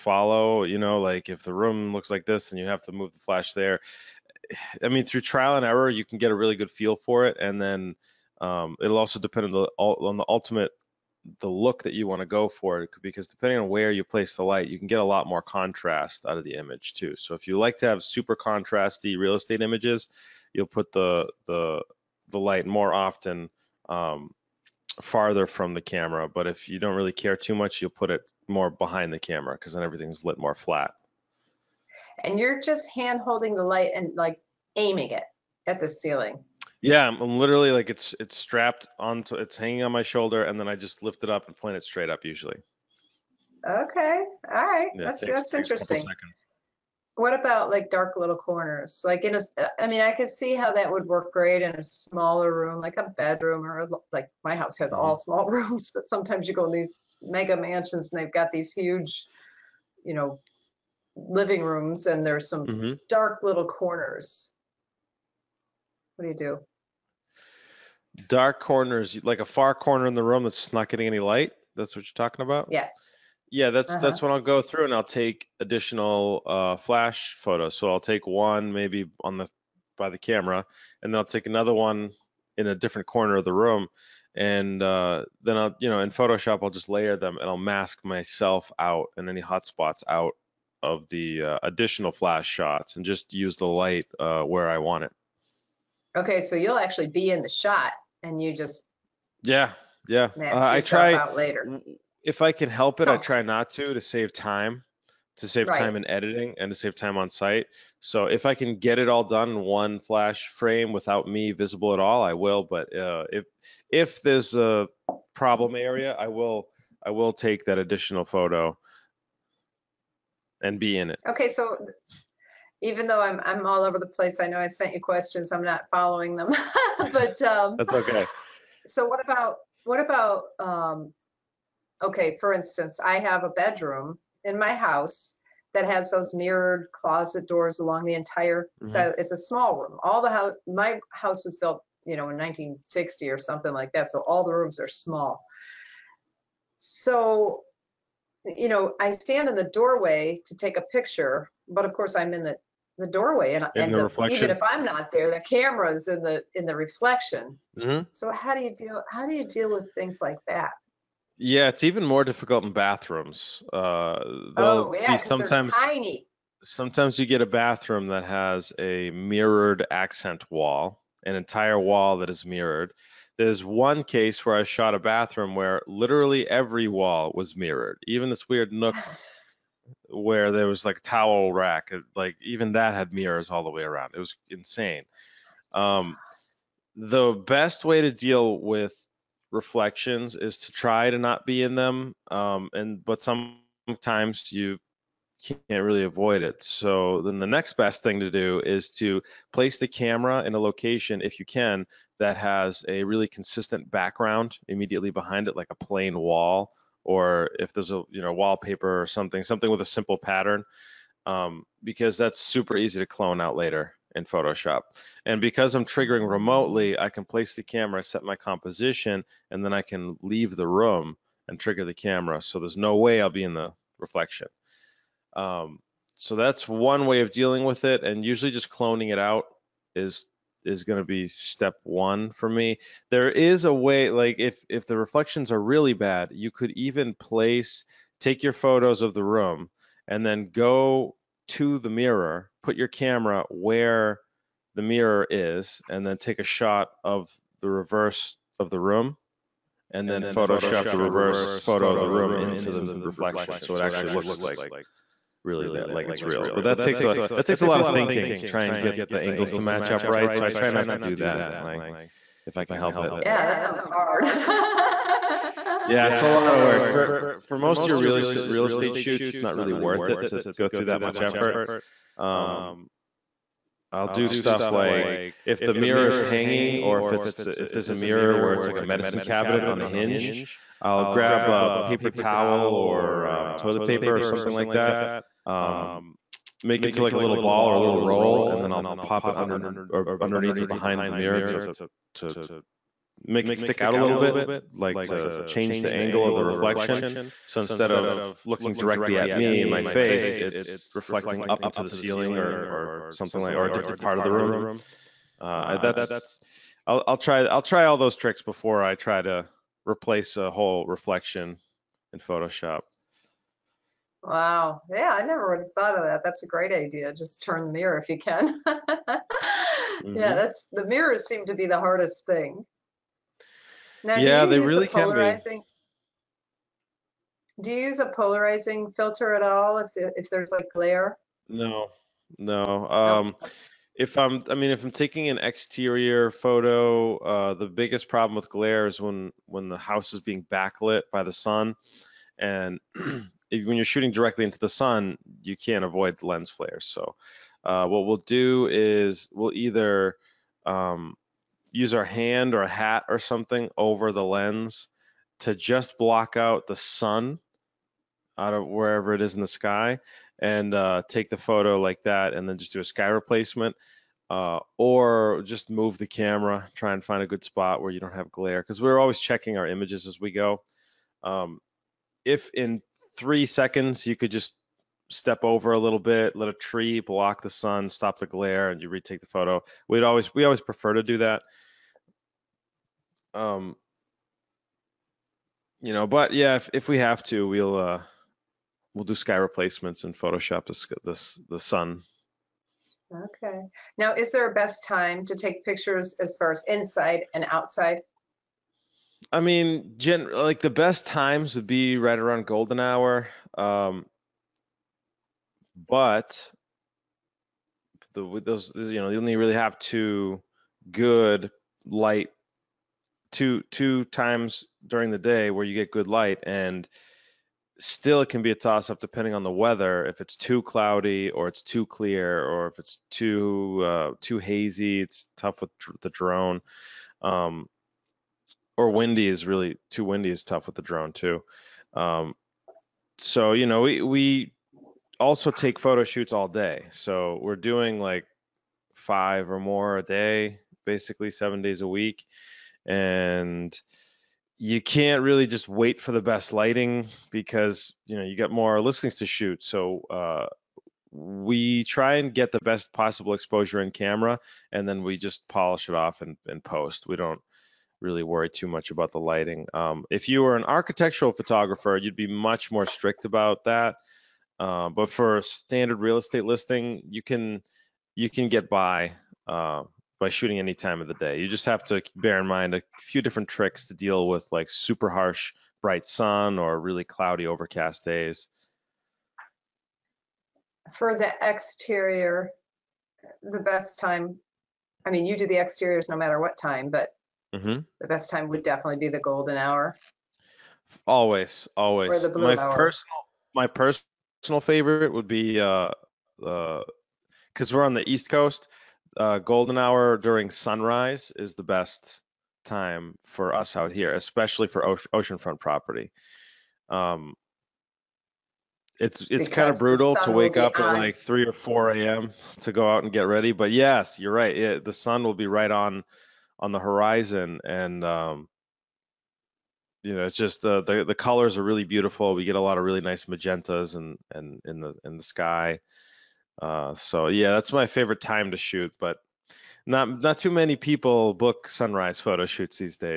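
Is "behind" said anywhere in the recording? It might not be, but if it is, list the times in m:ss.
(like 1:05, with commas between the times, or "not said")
0:28, 3:25, 4:50.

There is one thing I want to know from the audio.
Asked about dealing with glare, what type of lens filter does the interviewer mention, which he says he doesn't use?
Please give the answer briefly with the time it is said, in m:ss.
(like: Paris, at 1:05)
Polarizing filter, at 5:28.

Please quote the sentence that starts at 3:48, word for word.
And usually just cloning it out is is going to be step one for me.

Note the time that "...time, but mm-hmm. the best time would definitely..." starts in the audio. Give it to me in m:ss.
8:06.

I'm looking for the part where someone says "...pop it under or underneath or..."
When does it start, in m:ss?
4:49.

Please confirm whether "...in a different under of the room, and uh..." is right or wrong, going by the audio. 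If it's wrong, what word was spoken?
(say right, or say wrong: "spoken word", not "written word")
wrong: "corner", not "under".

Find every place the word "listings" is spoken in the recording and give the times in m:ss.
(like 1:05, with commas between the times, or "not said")
7:28, 7:46.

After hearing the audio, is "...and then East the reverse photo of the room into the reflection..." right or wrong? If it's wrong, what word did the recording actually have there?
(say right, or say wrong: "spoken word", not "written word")
wrong: "Photoshop", not "East".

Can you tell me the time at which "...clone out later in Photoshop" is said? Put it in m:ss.
3:33.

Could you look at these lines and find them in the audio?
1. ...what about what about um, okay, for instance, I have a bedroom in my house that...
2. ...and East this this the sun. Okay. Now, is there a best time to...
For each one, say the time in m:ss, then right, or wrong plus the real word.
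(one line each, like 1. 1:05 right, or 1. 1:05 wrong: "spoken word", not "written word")
1. 2:09 right
2. 6:30 wrong: "Photoshop", not "East".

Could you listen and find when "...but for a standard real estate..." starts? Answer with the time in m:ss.
7:44.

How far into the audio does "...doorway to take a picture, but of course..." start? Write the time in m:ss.
2:29.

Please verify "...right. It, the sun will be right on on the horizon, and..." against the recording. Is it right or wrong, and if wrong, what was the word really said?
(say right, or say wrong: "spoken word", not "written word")
right.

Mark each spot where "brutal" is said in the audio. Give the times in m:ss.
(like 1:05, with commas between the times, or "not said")
8:29.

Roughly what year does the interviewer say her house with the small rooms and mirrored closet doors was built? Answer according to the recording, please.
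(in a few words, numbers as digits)
1960.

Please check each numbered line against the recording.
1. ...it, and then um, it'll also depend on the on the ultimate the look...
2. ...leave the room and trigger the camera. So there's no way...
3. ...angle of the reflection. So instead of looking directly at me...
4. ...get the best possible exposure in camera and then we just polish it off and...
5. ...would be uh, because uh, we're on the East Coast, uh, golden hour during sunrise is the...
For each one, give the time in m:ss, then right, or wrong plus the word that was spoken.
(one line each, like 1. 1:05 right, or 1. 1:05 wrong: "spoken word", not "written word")
1. 0:07 right
2. 3:40 right
3. 4:55 right
4. 7:32 right
5. 8:15 right.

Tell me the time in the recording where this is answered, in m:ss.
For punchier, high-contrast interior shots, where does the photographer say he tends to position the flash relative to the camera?
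0:25.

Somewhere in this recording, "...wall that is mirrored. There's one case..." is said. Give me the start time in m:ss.
2:51.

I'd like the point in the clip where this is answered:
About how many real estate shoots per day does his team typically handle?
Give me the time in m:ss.
7:18.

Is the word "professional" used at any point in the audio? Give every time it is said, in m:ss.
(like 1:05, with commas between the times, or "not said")
not said.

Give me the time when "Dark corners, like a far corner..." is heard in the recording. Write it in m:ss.
1:08.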